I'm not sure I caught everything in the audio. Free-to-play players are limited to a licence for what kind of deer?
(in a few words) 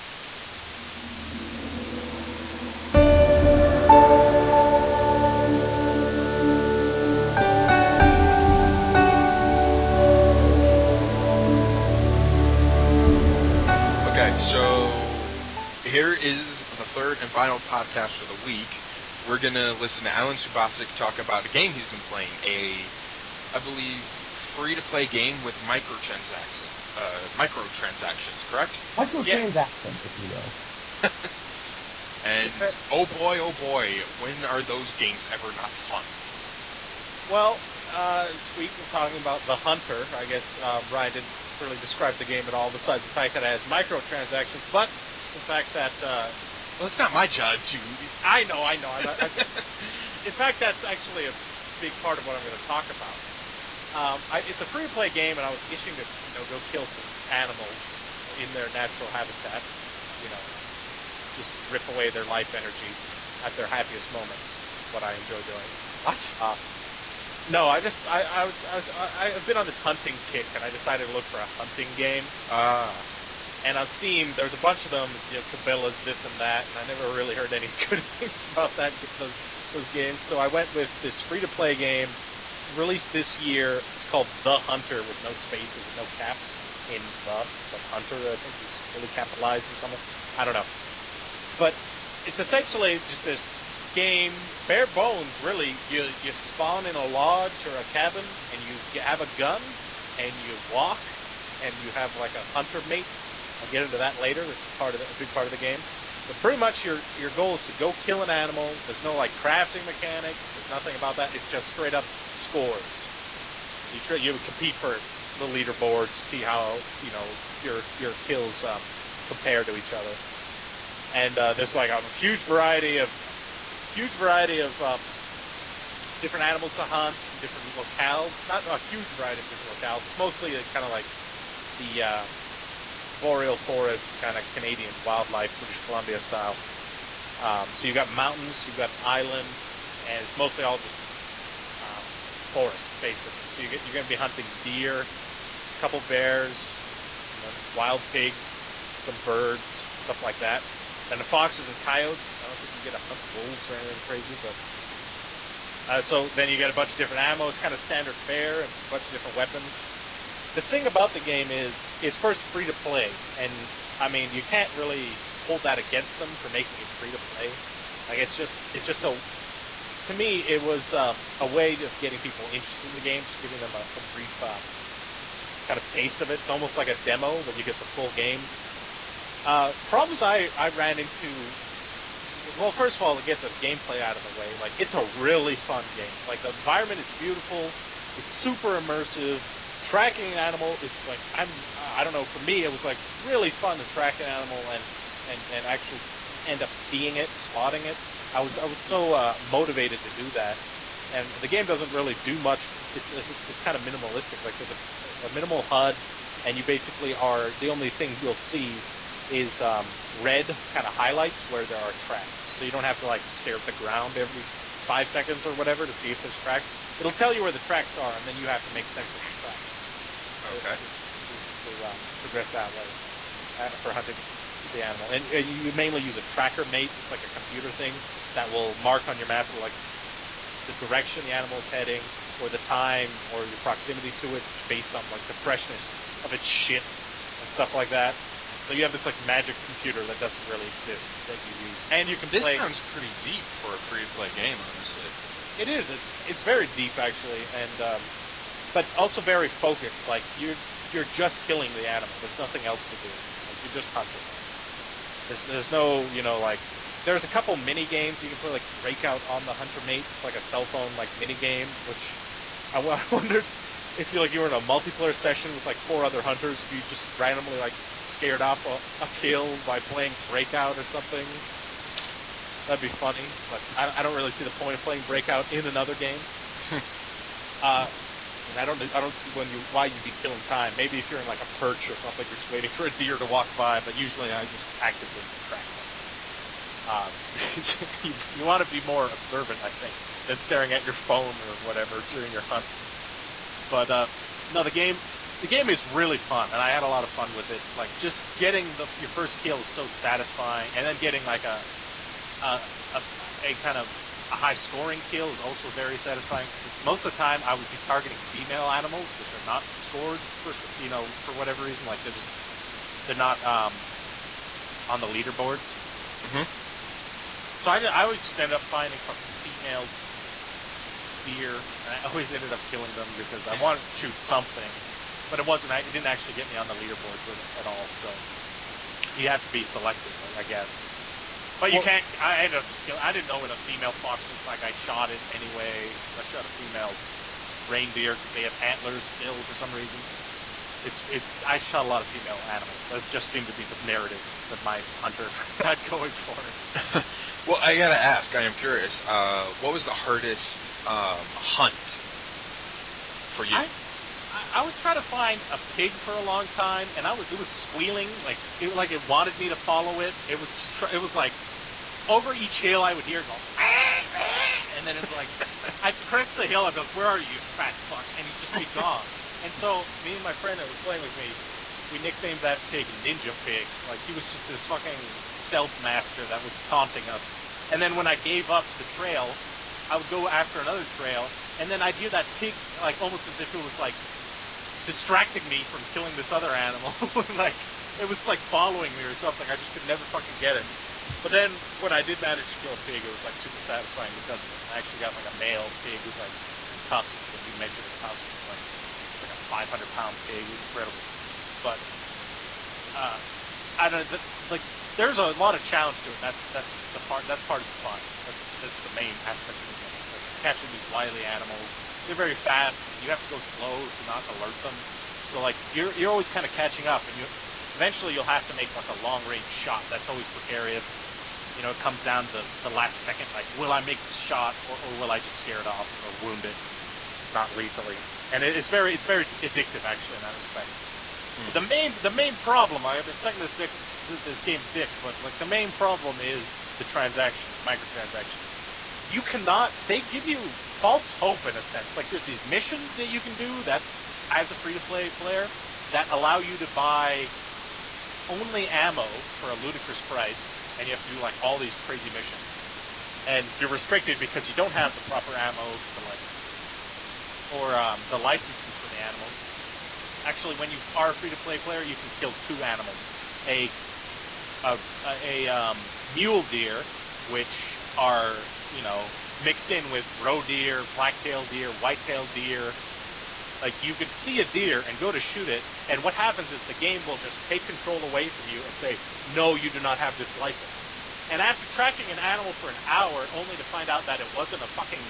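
mule deer.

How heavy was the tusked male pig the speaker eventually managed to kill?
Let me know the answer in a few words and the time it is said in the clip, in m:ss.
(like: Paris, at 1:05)
500 pounds, at 6:39.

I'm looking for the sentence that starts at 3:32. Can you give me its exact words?
So you don't have to like stare at the ground every five seconds or whatever to see if there's tracks.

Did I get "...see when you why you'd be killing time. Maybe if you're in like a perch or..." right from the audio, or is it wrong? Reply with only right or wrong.
right.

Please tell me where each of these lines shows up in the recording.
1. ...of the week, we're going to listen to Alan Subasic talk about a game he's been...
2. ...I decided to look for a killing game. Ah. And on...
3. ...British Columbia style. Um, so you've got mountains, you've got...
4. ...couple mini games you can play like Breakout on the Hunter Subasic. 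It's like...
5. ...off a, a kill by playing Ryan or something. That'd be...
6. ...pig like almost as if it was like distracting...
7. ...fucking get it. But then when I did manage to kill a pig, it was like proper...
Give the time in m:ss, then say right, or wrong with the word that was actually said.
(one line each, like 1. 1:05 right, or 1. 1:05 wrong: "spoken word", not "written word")
1. 0:18 right
2. 1:10 wrong: "hunting", not "killing"
3. 2:15 right
4. 4:17 wrong: "Mate", not "Subasic"
5. 4:28 wrong: "Breakout", not "Ryan"
6. 6:22 right
7. 6:30 wrong: "super", not "proper".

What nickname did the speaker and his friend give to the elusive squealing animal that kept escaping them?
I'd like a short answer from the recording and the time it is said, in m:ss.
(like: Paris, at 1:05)
Ninja Pig, at 6:12.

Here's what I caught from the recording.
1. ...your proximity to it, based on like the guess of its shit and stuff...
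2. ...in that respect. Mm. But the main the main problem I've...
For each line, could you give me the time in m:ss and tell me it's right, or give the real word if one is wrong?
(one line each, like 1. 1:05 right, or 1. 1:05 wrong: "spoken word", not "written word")
1. 3:53 wrong: "freshness", not "guess"
2. 7:10 right.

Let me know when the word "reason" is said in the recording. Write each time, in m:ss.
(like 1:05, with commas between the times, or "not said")
5:11, 5:39.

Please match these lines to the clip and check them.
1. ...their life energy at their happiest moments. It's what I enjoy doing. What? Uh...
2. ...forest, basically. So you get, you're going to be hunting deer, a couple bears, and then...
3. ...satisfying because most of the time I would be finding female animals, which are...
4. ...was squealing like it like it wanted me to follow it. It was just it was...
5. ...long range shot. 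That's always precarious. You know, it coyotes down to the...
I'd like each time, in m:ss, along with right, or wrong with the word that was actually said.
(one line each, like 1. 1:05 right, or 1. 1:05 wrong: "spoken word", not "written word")
1. 1:02 right
2. 2:22 right
3. 5:05 wrong: "targeting", not "finding"
4. 5:57 right
5. 6:58 wrong: "comes", not "coyotes".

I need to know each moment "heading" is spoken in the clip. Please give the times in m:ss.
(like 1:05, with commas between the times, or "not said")
3:51.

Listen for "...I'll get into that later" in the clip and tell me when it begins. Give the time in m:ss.
1:43.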